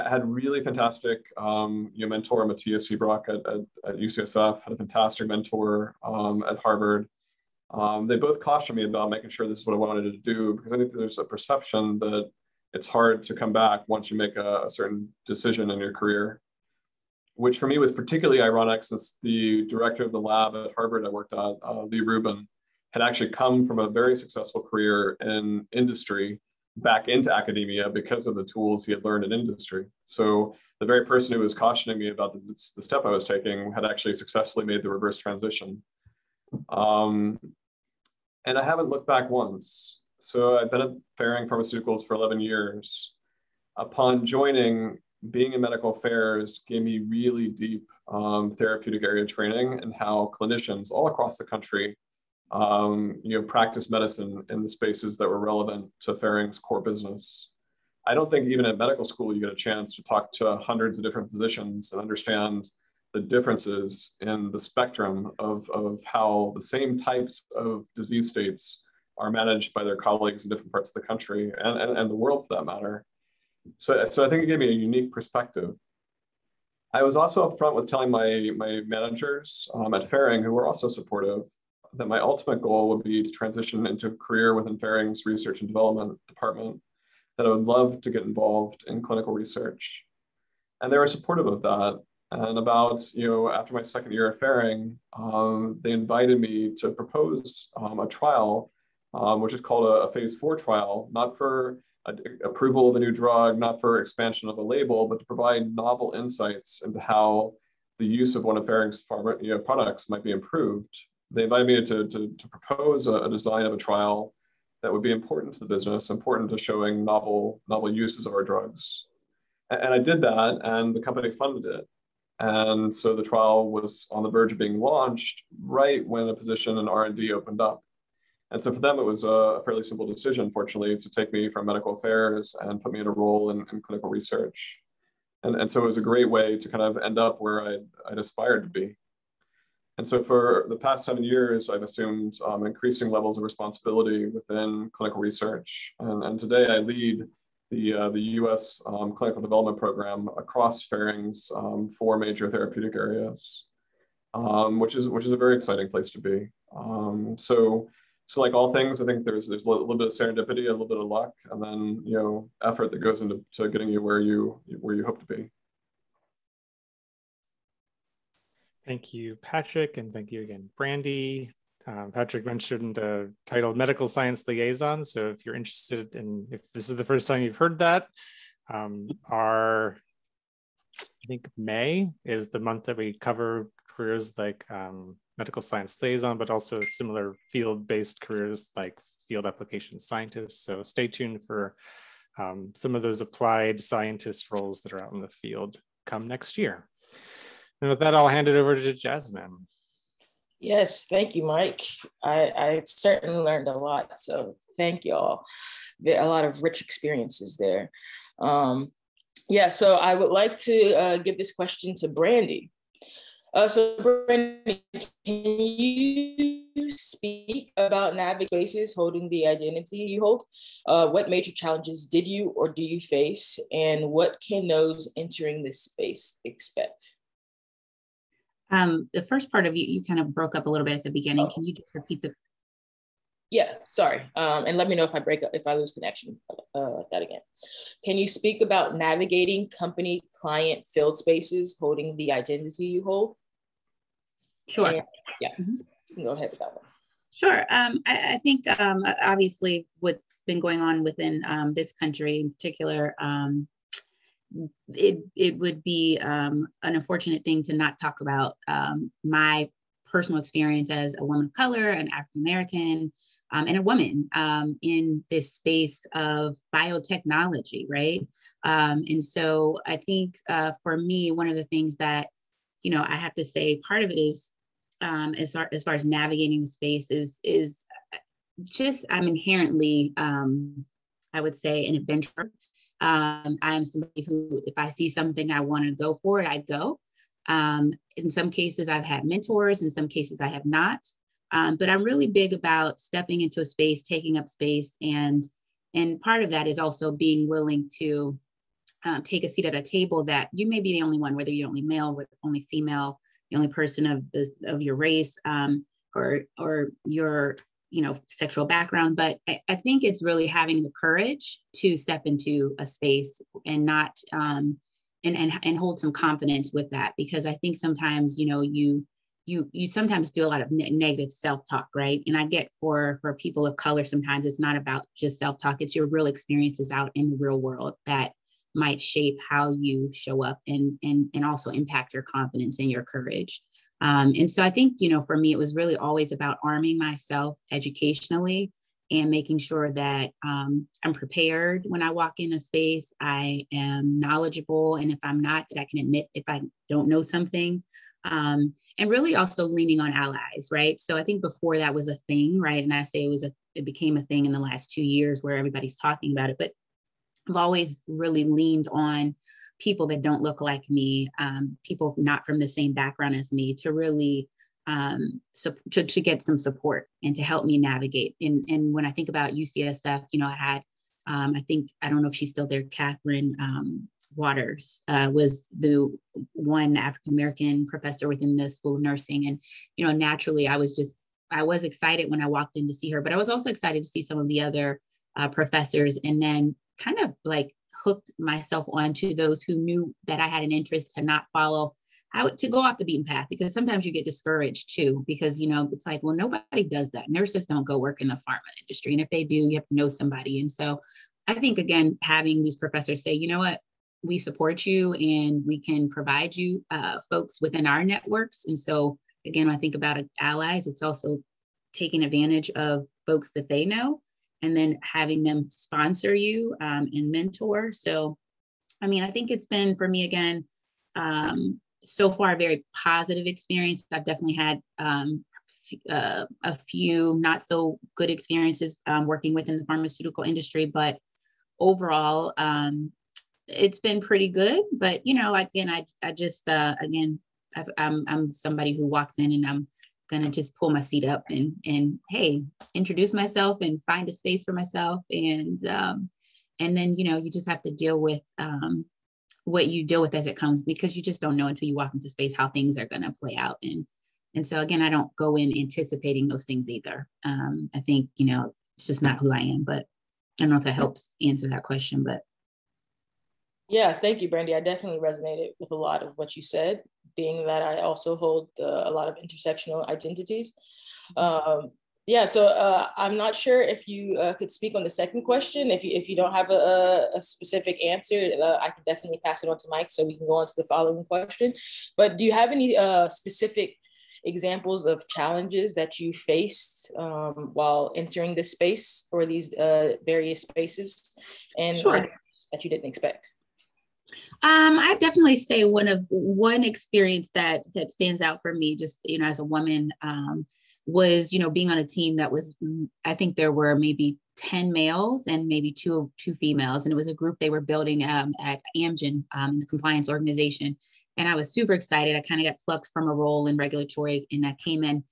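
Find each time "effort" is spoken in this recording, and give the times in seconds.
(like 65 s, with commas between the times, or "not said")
162 s.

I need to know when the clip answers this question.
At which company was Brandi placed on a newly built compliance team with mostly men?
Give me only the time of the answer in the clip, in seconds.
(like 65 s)
508 s.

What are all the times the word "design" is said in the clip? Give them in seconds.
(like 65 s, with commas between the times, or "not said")
113 s.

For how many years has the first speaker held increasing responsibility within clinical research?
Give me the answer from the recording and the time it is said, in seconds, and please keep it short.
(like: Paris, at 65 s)
7, at 141 s.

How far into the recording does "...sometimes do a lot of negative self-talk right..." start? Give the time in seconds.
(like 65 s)
319 s.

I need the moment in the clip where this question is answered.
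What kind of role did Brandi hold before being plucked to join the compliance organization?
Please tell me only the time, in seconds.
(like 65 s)
513 s.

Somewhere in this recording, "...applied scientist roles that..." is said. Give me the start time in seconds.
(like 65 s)
193 s.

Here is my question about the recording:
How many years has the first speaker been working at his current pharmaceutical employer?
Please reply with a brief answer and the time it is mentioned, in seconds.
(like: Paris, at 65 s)
11, at 42 s.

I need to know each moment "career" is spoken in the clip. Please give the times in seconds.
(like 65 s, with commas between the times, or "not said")
15 s, 24 s, 84 s, 183 s, 188 s.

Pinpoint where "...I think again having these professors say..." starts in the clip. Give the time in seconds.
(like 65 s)
401 s.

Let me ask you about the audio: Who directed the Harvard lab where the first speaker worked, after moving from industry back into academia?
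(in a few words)
Lee Rubin.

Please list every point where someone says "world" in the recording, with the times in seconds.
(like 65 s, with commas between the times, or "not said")
72 s, 327 s.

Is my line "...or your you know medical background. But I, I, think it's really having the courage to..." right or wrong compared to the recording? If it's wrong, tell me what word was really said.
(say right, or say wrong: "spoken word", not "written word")
wrong: "sexual", not "medical".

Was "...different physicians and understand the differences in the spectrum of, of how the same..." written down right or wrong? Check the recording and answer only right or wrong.
right.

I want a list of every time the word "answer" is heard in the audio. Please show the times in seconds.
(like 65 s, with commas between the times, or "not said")
461 s, 478 s.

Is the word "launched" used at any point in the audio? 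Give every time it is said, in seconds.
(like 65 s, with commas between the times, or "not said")
124 s.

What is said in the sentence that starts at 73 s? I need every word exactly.
So, so I think it gave me a unique perspective.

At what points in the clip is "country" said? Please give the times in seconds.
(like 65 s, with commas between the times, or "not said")
51 s, 71 s, 251 s.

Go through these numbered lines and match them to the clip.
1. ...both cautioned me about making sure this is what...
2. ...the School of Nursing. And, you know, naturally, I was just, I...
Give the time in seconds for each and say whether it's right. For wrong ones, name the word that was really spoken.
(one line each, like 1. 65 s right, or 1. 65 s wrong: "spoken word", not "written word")
1. 8 s right
2. 378 s right.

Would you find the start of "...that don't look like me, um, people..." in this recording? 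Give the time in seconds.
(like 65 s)
360 s.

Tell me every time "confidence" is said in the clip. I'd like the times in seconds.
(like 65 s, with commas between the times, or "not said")
316 s, 332 s.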